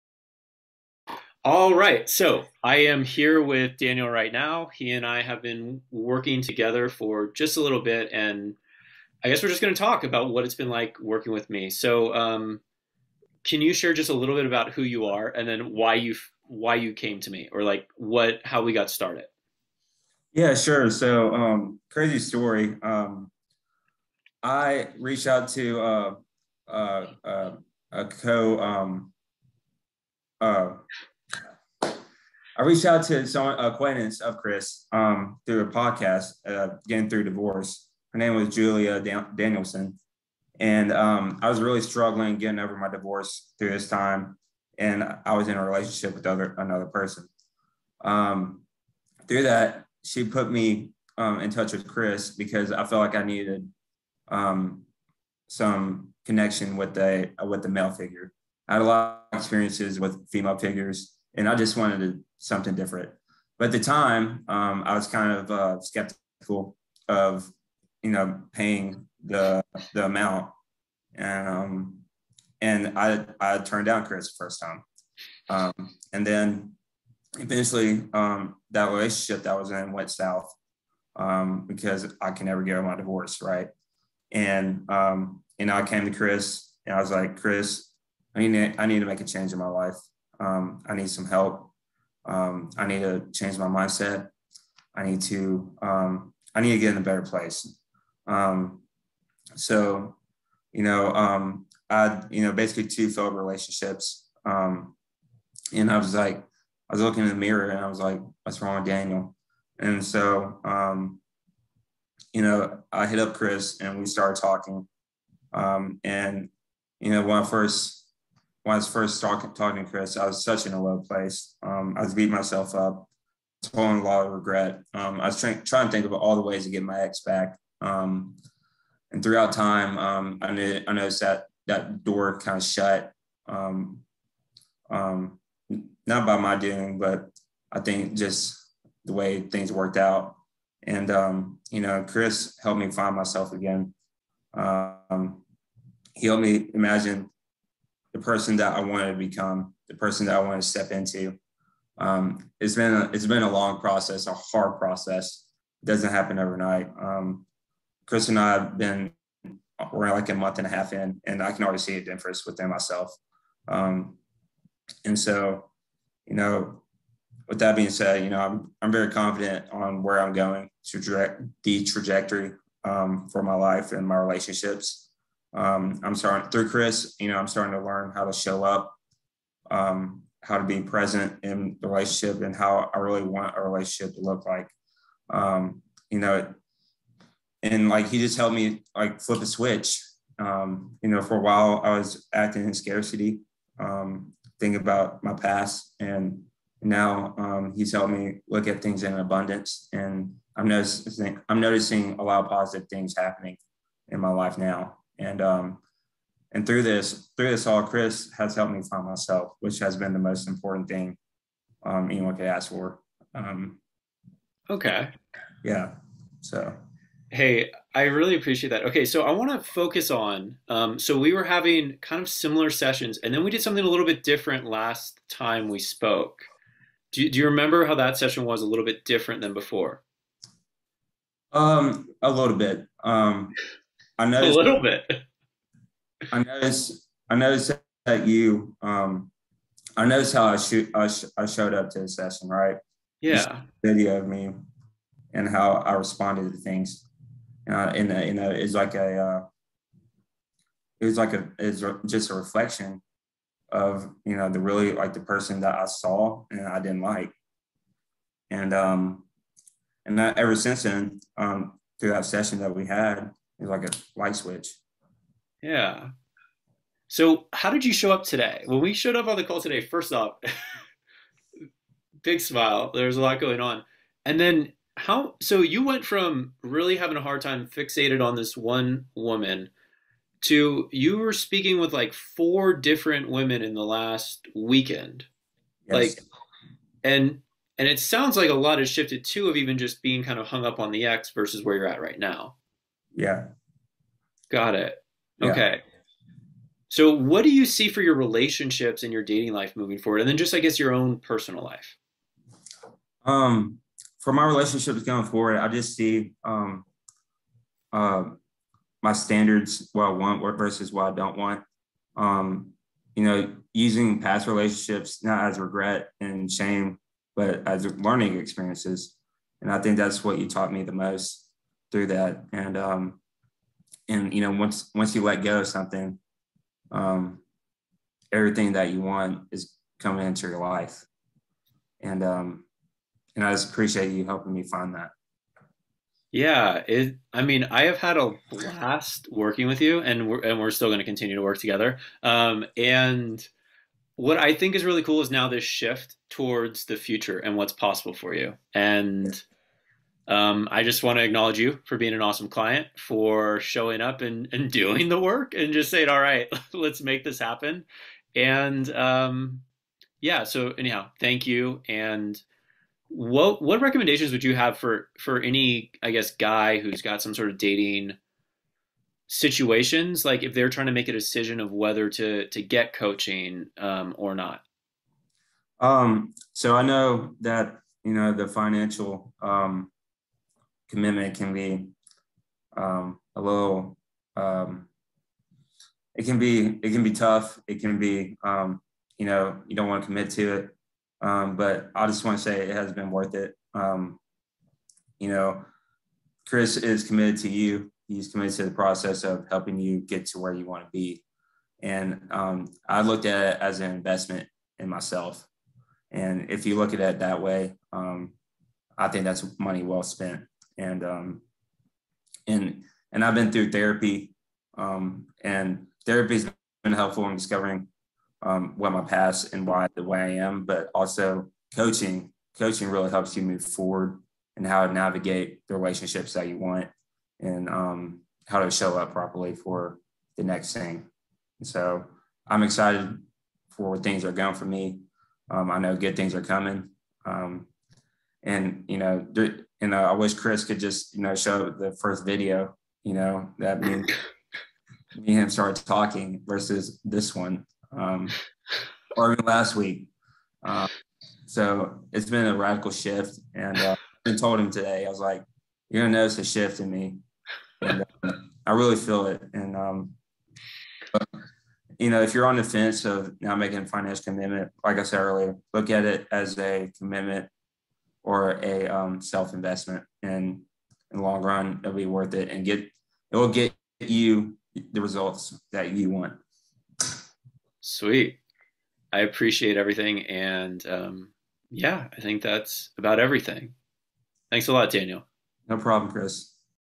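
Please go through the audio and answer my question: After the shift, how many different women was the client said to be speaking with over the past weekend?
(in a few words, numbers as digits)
4.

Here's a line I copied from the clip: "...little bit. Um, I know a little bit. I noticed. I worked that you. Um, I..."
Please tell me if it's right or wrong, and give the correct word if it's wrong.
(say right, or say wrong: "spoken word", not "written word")
wrong: "noticed", not "worked".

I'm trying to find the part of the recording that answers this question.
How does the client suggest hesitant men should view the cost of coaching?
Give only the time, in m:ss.
6:43.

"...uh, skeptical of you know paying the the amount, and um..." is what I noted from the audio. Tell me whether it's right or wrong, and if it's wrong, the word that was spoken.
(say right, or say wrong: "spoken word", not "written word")
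right.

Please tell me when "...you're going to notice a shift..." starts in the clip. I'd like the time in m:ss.
7:35.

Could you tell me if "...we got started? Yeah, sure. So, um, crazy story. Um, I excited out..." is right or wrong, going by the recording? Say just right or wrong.
wrong.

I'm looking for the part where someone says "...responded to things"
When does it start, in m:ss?
4:05.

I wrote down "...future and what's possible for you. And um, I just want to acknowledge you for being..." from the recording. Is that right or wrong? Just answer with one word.
right.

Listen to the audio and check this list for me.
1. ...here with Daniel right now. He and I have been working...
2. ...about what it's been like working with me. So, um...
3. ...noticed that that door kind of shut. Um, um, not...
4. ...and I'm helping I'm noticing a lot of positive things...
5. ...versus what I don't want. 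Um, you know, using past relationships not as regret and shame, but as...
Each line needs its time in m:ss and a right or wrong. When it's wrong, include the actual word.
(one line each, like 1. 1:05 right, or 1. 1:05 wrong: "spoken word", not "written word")
1. 0:03 right
2. 0:10 right
3. 2:10 right
4. 3:19 wrong: "noticing", not "helping"
5. 5:10 right.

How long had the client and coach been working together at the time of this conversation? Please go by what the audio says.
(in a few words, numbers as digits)
a month and a half.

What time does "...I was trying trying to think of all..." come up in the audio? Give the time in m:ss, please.
2:05.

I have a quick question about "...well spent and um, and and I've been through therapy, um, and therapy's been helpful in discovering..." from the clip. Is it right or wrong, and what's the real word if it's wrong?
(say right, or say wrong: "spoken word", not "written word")
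right.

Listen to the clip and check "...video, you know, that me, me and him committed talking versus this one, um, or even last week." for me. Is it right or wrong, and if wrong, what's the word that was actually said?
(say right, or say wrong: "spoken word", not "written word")
wrong: "started", not "committed".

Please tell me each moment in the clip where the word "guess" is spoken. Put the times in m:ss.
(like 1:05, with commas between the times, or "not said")
0:09, 5:00, 6:06.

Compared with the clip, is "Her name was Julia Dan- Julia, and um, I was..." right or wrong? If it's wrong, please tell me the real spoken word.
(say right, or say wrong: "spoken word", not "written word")
wrong: "Danielson", not "Julia".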